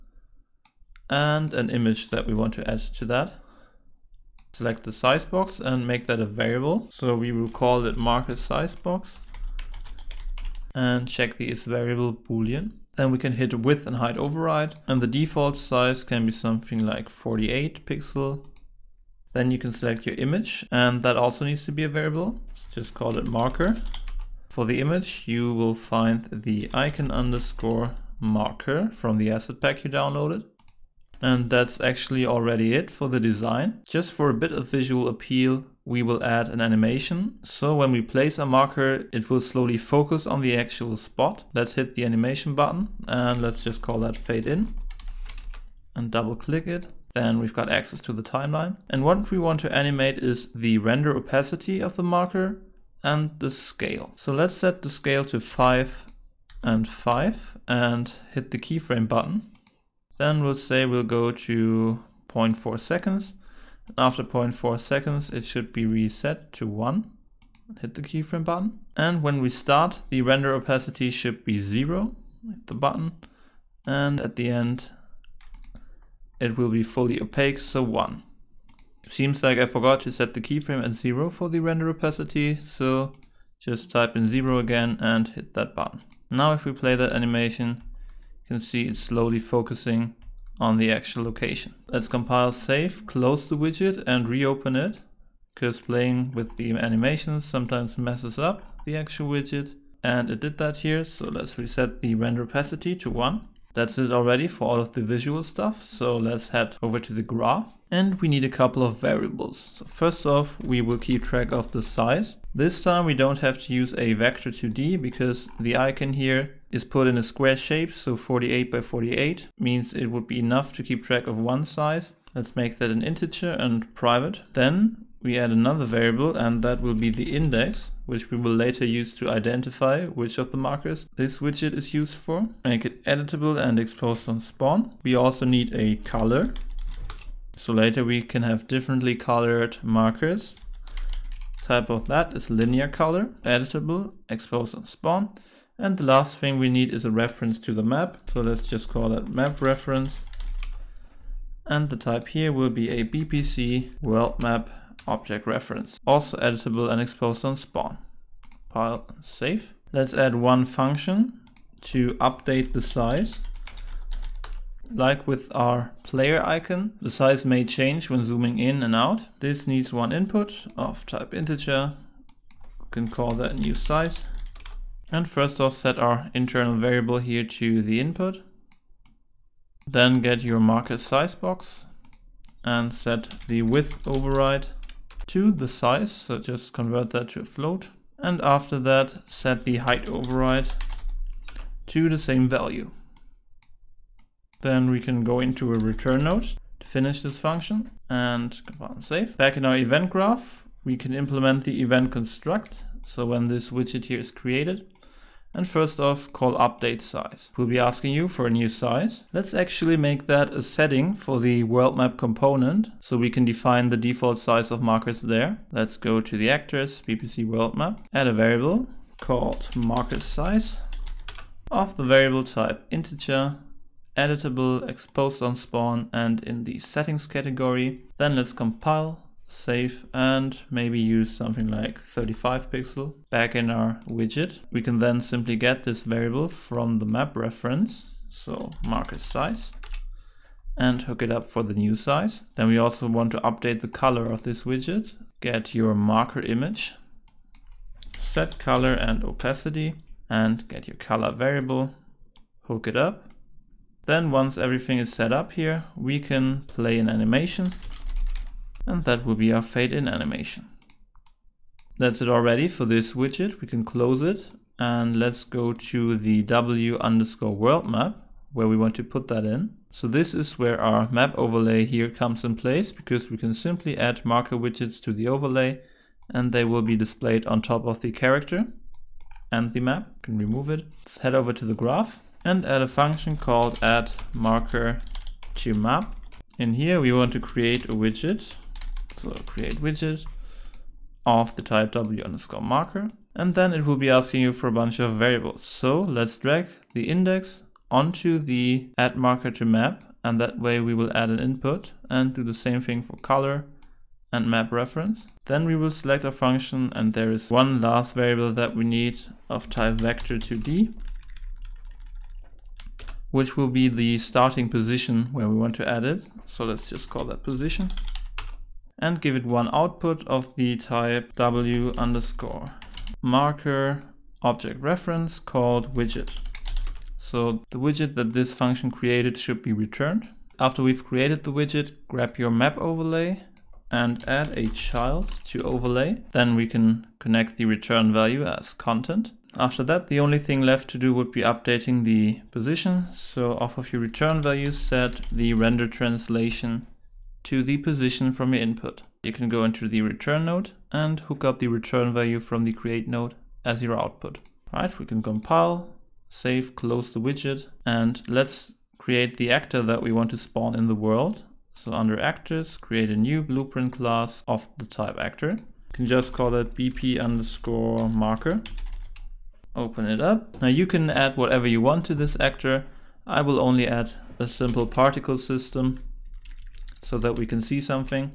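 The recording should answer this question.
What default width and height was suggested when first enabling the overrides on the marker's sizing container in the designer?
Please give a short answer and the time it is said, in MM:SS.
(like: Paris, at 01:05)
48 pixel, at 00:17.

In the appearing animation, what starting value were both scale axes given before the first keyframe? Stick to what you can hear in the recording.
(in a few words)
5.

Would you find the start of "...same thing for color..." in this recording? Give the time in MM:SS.
05:02.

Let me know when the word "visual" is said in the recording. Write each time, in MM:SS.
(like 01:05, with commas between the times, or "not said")
00:34, 01:45.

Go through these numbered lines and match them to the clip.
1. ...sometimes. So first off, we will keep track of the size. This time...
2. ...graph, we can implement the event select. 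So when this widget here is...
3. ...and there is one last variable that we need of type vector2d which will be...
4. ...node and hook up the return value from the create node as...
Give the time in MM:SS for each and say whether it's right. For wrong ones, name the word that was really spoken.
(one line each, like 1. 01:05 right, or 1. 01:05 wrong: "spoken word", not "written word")
1. 01:48 wrong: "variables", not "sometimes"
2. 03:20 wrong: "construct", not "select"
3. 05:06 right
4. 05:50 right.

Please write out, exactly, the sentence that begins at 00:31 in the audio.
And that's actually already it for the design.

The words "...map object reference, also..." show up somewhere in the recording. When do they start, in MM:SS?
02:34.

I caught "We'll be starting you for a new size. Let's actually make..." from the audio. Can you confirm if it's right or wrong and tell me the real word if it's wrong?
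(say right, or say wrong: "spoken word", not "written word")
wrong: "asking", not "starting".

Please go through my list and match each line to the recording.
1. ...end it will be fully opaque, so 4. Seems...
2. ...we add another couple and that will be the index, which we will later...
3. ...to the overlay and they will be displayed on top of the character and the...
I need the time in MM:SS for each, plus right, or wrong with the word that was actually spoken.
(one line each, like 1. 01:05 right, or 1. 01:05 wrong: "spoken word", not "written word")
1. 01:14 wrong: "1", not "4"
2. 02:05 wrong: "variable", not "couple"
3. 04:35 right.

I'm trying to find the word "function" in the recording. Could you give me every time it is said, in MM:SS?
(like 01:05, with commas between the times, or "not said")
02:40, 03:17, 04:42, 05:06, 05:28.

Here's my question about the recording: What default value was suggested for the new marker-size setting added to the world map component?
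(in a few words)
35 pixel.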